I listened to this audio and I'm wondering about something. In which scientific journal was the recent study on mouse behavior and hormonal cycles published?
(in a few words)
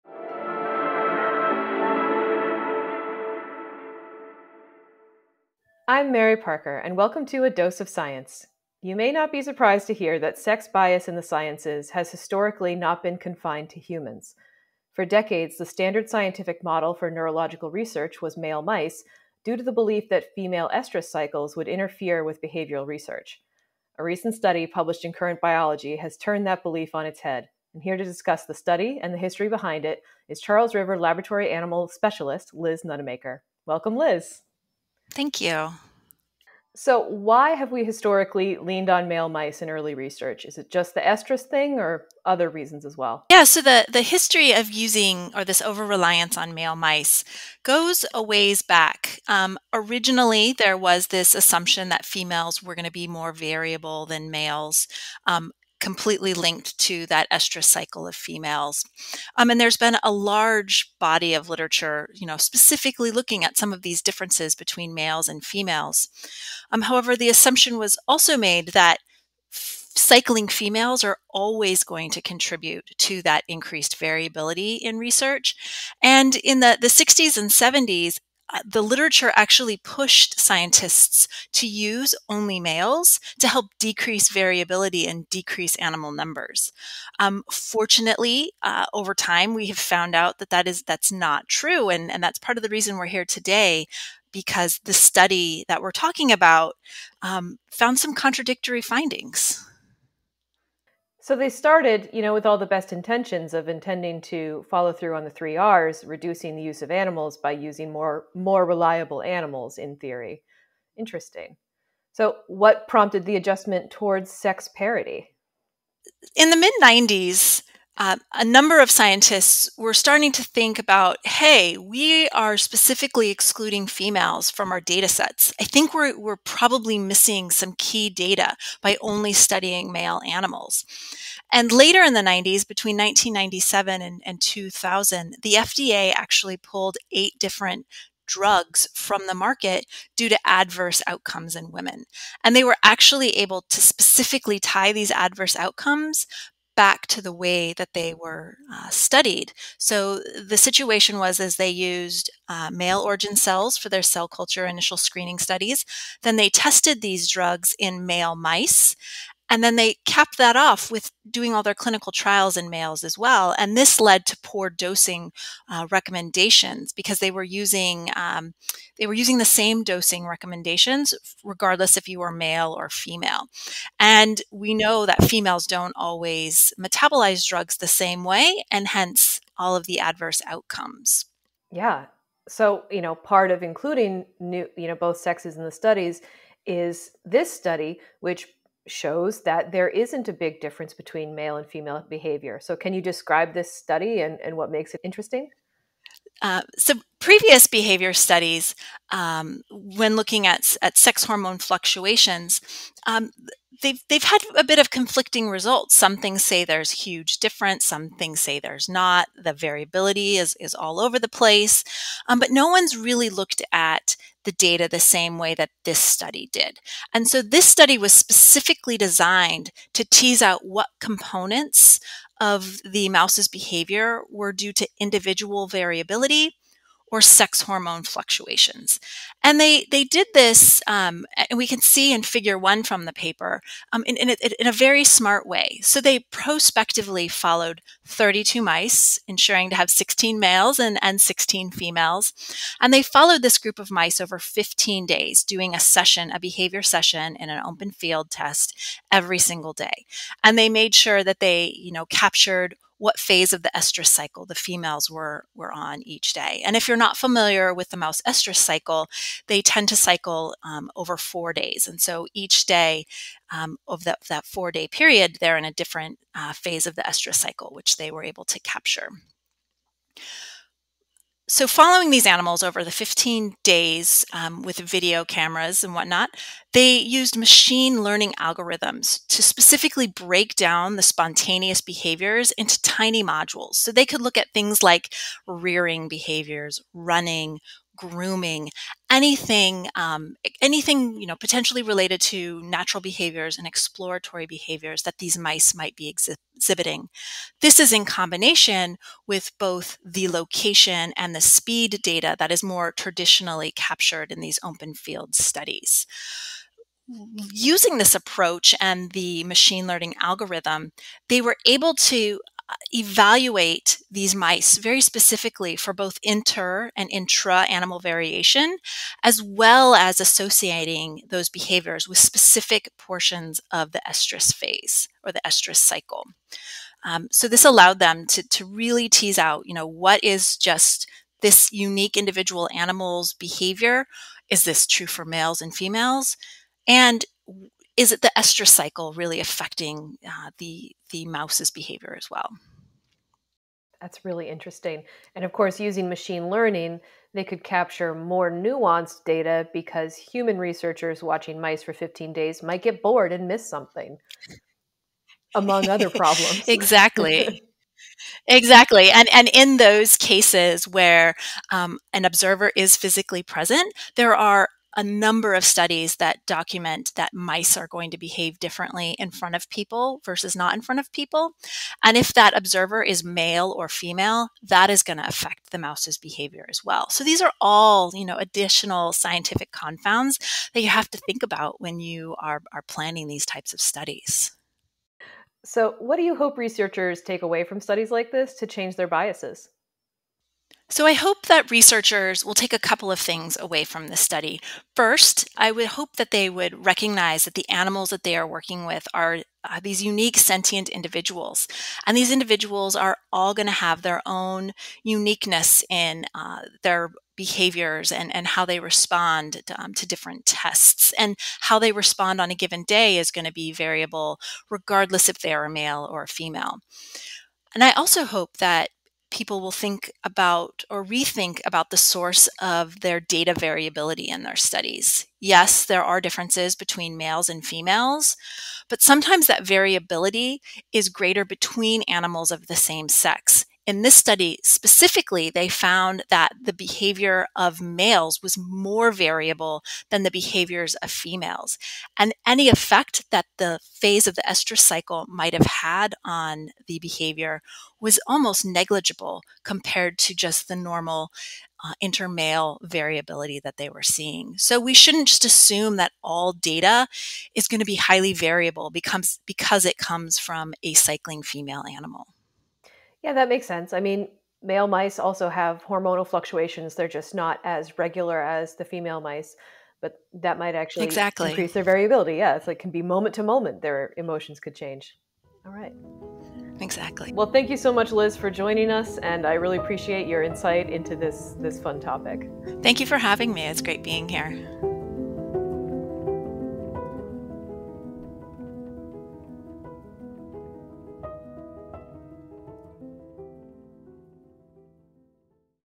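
Current Biology.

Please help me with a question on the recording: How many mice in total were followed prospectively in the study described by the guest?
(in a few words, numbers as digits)
32.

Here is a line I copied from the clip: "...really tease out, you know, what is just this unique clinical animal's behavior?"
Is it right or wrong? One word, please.
wrong.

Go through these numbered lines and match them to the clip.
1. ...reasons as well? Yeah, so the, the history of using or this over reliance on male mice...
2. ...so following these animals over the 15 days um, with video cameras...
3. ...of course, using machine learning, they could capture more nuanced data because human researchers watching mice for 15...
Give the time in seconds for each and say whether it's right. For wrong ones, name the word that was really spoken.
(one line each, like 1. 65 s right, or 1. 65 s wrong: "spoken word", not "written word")
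1. 42 s right
2. 271 s right
3. 345 s right.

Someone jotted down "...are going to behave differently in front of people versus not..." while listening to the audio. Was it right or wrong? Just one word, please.
right.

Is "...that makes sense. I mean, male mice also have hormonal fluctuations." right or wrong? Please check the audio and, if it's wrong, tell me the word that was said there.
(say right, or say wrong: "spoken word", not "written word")
right.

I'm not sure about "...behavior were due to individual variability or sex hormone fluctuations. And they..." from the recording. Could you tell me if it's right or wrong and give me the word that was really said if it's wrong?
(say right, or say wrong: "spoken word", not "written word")
right.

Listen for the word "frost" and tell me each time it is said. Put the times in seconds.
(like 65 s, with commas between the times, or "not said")
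not said.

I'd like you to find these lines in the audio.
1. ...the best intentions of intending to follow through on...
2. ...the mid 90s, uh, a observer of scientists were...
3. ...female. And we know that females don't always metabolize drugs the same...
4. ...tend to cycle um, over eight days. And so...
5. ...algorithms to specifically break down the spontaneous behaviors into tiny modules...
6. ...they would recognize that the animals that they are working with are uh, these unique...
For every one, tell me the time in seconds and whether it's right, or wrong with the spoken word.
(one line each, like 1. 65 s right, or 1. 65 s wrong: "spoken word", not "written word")
1. 102 s right
2. 116 s wrong: "number", not "observer"
3. 172 s right
4. 259 s wrong: "four", not "eight"
5. 278 s right
6. 396 s right.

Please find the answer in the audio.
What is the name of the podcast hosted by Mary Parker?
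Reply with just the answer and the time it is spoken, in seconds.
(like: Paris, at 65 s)
A Dose of Science, at 7 s.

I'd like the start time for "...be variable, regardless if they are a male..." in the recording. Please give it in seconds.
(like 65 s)
413 s.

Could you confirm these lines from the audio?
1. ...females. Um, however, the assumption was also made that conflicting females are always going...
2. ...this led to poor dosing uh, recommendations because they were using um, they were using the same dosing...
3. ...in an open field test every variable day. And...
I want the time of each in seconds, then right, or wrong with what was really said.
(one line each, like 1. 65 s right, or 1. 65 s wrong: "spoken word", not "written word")
1. 65 s wrong: "cycling", not "conflicting"
2. 163 s right
3. 247 s wrong: "single", not "variable".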